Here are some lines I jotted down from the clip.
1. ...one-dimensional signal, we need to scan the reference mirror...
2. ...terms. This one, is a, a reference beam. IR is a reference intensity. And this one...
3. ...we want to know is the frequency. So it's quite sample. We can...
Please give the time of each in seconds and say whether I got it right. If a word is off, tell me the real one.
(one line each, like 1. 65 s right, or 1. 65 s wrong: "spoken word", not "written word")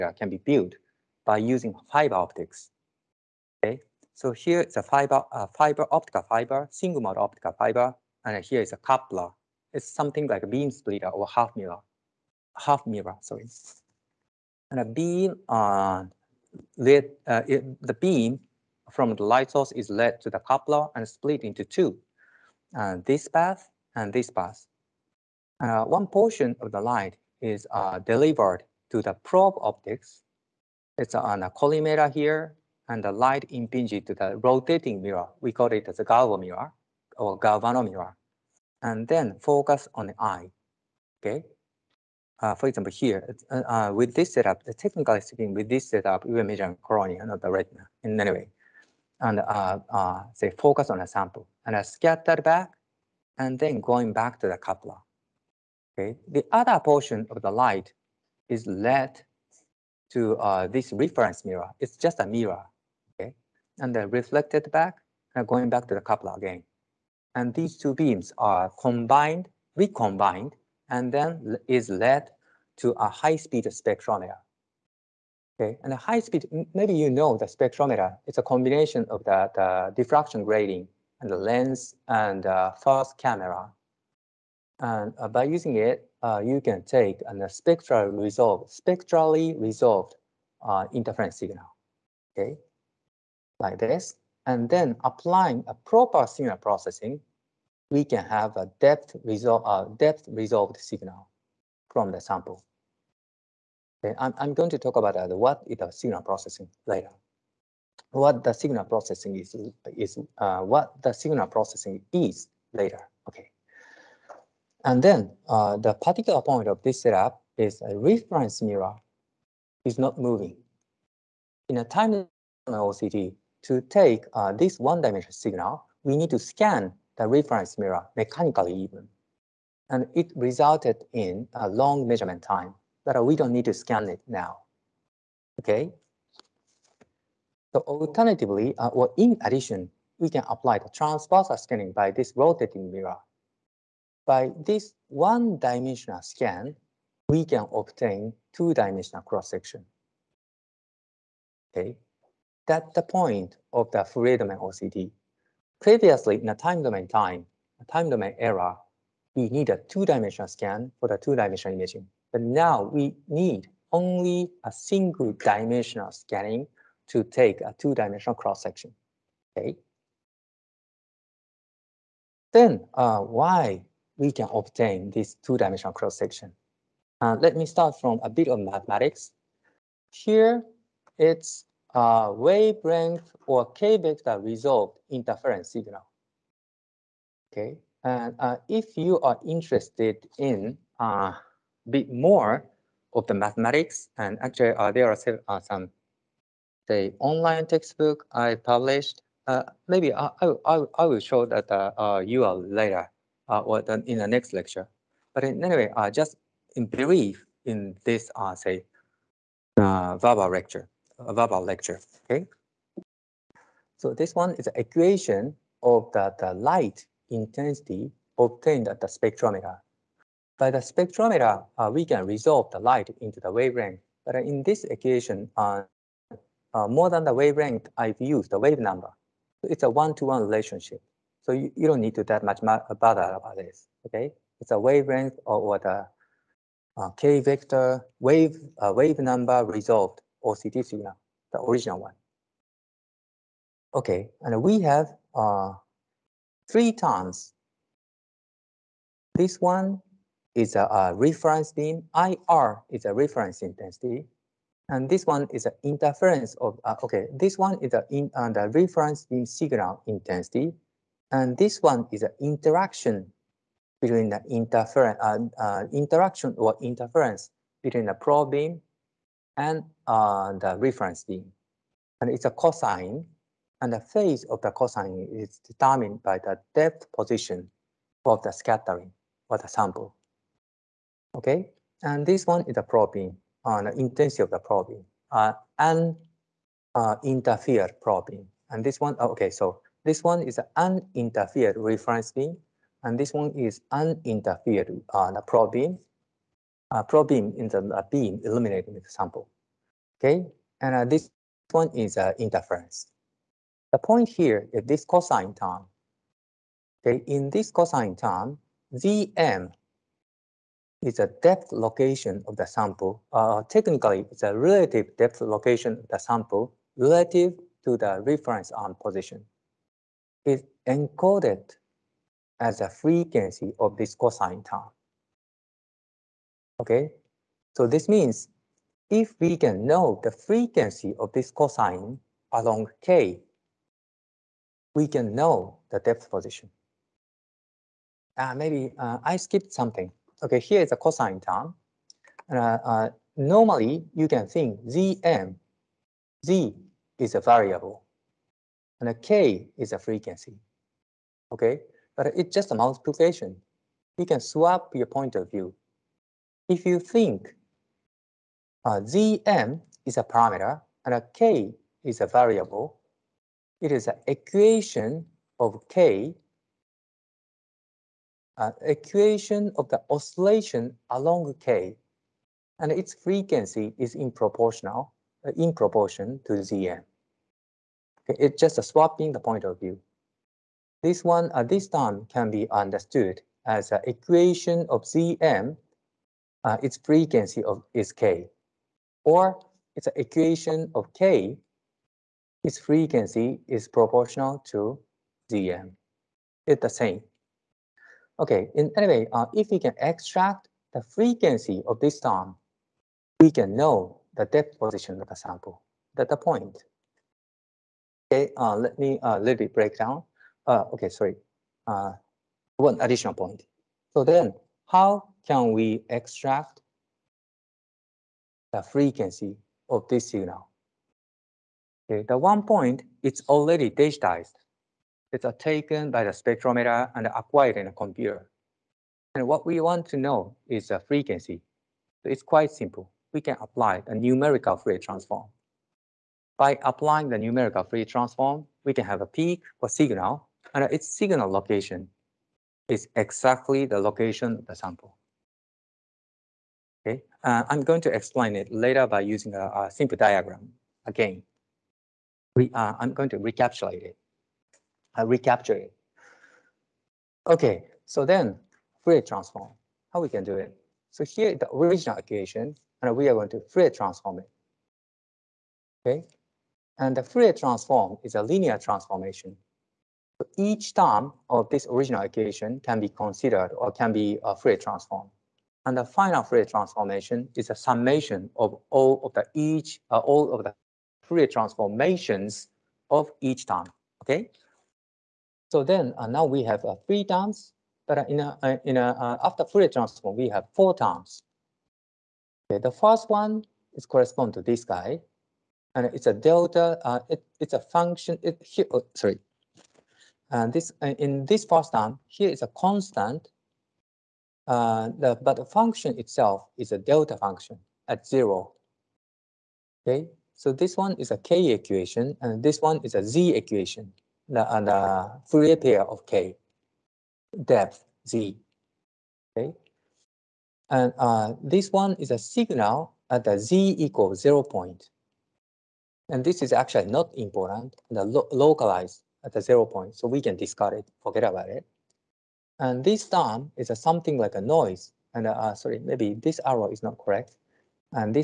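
1. 124 s right
2. 246 s right
3. 429 s wrong: "simple", not "sample".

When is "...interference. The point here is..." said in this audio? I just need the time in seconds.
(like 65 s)
302 s.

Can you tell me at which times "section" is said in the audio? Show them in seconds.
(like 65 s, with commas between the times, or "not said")
149 s, 168 s, 175 s.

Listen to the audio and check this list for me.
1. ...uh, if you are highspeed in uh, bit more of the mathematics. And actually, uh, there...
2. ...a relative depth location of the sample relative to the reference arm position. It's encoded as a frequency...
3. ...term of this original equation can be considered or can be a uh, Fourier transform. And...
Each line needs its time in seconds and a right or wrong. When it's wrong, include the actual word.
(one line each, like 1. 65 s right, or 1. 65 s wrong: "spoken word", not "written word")
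1. 188 s wrong: "interested", not "highspeed"
2. 314 s right
3. 470 s right.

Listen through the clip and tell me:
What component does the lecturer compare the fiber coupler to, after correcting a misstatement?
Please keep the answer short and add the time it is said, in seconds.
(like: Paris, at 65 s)
Half mirror, at 12 s.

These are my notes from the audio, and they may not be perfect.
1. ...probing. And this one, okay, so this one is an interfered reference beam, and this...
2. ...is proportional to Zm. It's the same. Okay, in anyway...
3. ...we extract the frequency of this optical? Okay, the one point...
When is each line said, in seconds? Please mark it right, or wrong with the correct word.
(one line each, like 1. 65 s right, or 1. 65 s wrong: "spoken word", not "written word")
1. 288 s wrong: "uninterfered", not "interfered"
2. 393 s right
3. 415 s wrong: "signal", not "optical".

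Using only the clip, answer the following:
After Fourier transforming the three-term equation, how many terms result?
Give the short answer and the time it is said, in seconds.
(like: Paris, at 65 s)
4, at 490 s.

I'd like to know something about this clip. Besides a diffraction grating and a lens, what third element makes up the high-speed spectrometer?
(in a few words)
Fast camera.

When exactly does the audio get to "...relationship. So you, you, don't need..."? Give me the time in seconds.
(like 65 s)
230 s.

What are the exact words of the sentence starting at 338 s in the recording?
Uh, maybe uh, I skipped something.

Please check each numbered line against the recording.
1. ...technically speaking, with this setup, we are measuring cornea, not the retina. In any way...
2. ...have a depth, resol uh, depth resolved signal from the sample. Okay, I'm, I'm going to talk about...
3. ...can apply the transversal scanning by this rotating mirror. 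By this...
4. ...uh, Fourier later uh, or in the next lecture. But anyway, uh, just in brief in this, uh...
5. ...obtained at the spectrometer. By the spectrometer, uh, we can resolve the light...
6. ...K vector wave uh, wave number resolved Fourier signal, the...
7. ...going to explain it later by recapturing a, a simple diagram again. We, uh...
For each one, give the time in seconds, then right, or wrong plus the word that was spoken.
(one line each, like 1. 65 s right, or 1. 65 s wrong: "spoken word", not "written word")
1. 44 s right
2. 98 s right
3. 140 s right
4. 201 s wrong: "URL", not "Fourier"
5. 218 s right
6. 237 s wrong: "OCT", not "Fourier"
7. 447 s wrong: "using", not "recapturing".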